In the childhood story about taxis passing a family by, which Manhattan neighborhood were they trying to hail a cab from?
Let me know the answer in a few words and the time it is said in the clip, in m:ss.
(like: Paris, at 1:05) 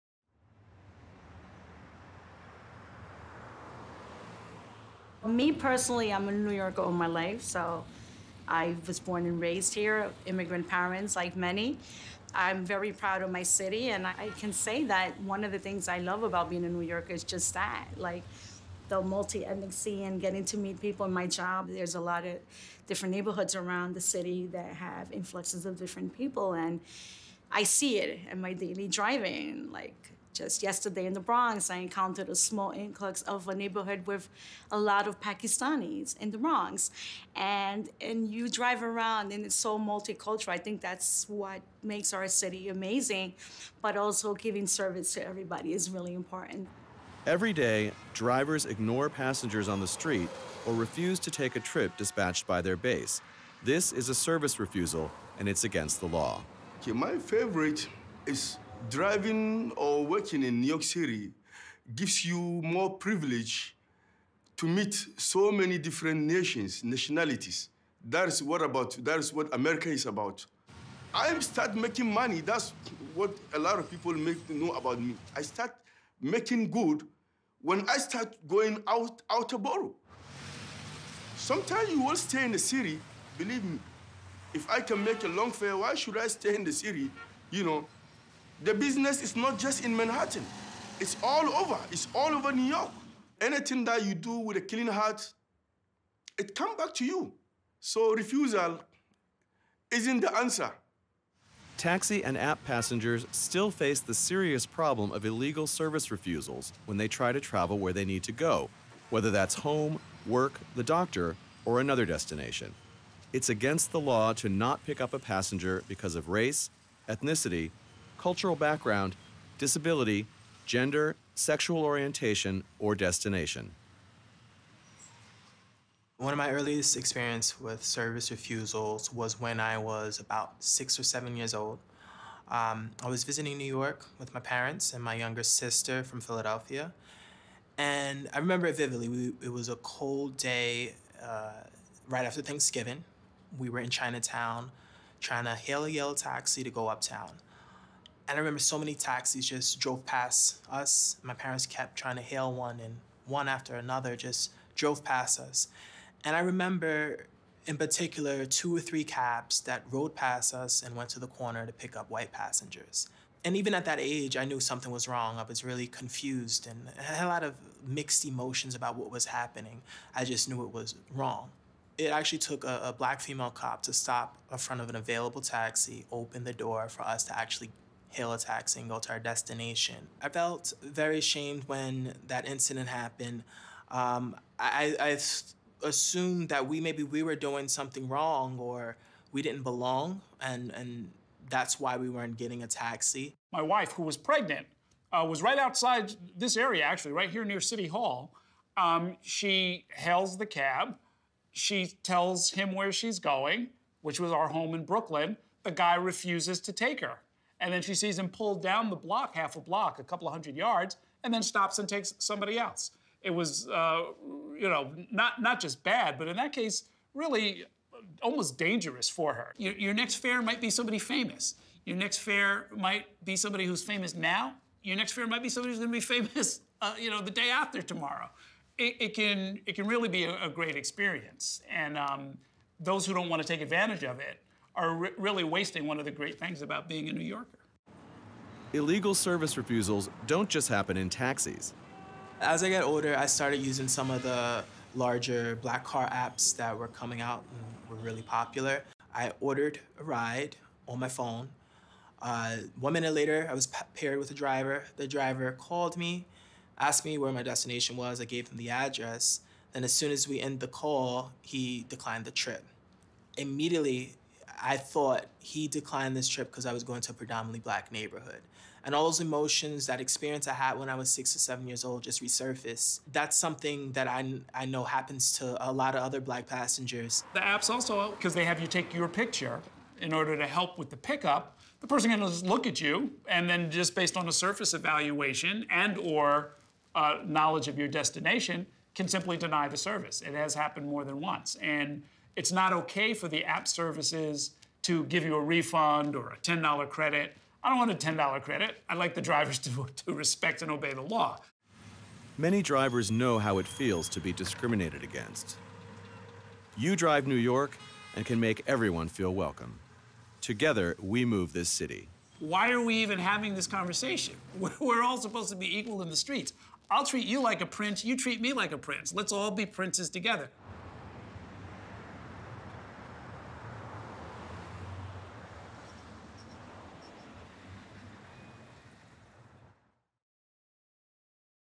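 Chinatown, at 2:23.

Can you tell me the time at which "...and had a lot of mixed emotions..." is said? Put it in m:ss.
2:46.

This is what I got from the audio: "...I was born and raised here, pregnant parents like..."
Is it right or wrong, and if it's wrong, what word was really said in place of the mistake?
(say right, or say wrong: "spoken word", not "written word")
wrong: "immigrant", not "pregnant".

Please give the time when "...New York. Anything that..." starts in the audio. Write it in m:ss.
1:32.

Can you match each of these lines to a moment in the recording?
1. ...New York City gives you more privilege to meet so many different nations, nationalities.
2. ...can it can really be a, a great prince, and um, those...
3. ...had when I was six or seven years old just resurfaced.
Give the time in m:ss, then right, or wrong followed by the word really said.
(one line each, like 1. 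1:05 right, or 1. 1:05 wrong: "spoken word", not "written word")
1. 1:00 right
2. 3:49 wrong: "experience", not "prince"
3. 4:30 right.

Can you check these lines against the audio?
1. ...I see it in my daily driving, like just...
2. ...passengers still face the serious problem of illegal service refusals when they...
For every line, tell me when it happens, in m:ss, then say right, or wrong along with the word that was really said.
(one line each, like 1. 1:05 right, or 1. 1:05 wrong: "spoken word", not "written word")
1. 0:27 right
2. 1:42 right.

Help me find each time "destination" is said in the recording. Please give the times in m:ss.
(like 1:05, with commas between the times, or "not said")
1:52, 2:02, 2:59, 4:17, 4:47.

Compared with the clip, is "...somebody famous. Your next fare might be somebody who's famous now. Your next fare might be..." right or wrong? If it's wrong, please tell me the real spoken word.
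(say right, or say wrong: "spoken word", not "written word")
right.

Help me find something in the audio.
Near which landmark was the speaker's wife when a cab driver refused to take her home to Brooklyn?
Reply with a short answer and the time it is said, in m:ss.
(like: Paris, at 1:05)
City Hall, at 3:17.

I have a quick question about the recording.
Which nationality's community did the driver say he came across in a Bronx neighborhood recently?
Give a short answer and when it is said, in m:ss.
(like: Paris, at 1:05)
Pakistanis, at 0:35.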